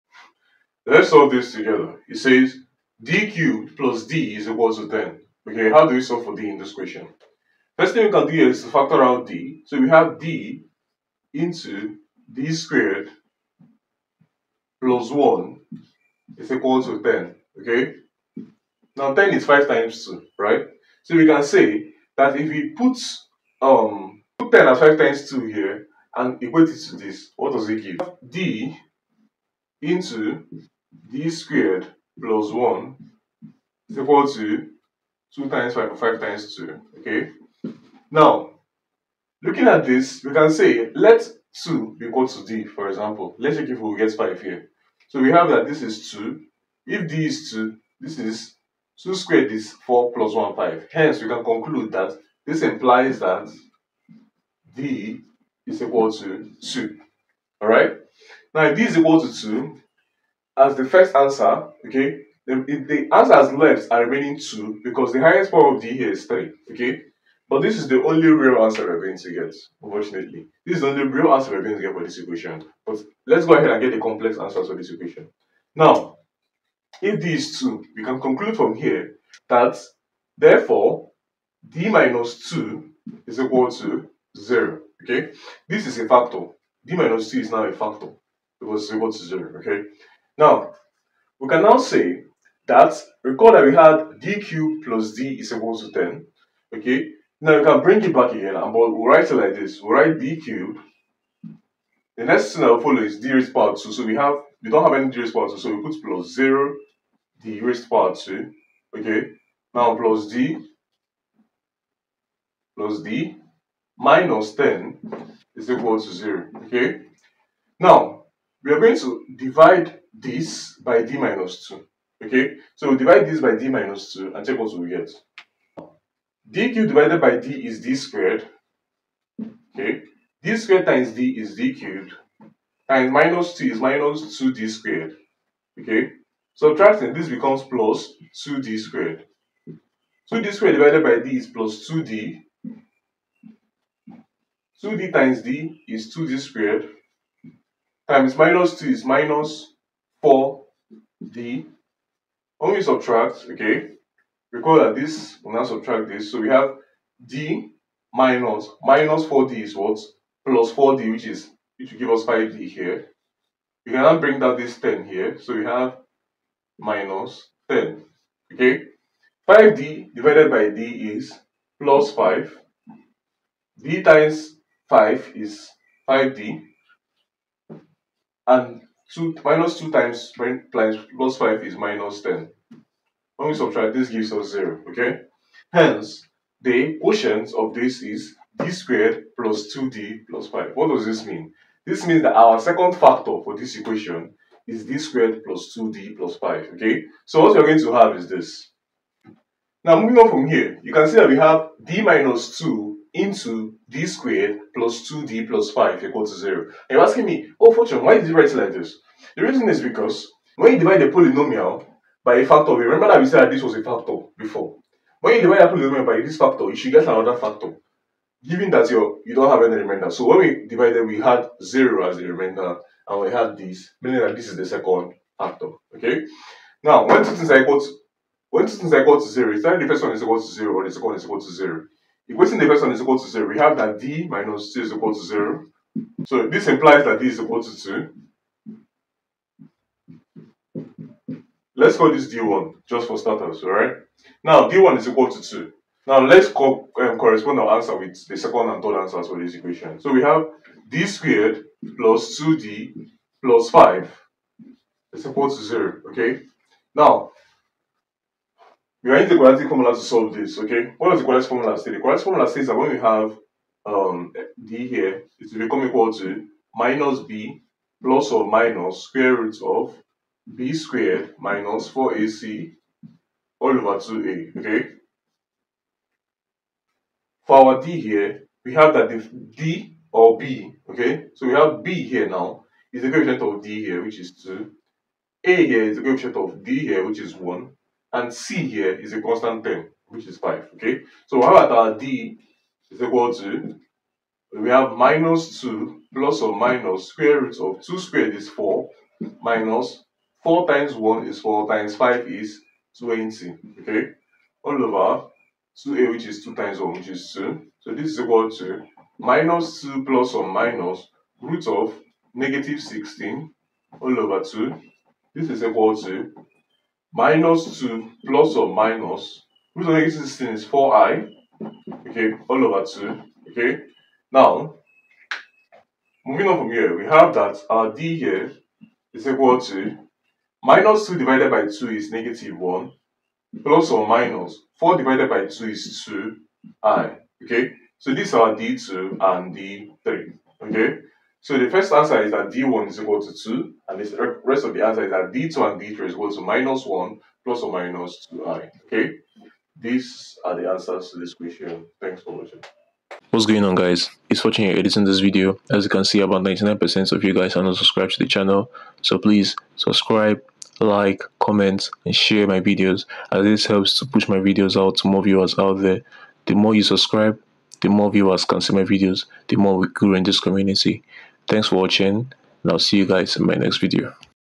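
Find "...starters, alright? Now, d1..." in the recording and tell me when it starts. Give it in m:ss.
4:03.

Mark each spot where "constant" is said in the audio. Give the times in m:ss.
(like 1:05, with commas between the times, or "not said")
4:49.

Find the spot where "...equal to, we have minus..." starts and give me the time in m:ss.
4:53.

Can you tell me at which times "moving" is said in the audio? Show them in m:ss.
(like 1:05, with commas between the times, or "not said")
3:20, 5:26.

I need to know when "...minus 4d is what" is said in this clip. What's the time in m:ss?
2:38.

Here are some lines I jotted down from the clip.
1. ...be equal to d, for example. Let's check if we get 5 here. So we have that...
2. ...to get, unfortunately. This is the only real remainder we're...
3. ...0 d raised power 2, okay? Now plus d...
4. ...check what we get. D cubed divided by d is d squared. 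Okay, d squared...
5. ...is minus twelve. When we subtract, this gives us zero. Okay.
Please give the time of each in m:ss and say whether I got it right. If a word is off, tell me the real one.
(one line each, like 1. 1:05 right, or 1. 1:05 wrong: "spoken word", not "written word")
1. 0:41 right
2. 1:09 wrong: "answer", not "remainder"
3. 1:46 right
4. 2:04 right
5. 3:01 wrong: "ten", not "twelve".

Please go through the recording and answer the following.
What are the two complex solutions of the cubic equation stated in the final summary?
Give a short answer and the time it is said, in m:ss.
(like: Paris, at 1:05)
-1 ± 2i, at 5:46.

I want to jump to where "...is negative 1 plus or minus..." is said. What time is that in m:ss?
5:31.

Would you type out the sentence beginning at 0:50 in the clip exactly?
Hence, we can conclude that this implies that d is equal to 2.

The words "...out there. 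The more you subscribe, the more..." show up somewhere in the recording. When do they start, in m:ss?
6:05.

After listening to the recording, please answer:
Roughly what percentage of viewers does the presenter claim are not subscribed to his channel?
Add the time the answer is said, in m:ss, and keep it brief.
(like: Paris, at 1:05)
99%, at 5:56.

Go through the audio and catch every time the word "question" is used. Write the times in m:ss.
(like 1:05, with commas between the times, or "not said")
0:06, 5:51.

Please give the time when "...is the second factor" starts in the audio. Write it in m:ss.
3:44.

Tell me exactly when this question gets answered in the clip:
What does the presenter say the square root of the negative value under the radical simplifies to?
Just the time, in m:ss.
5:20.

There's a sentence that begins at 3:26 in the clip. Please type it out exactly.
And you're asking me, oh Fortune, why did you write it like this?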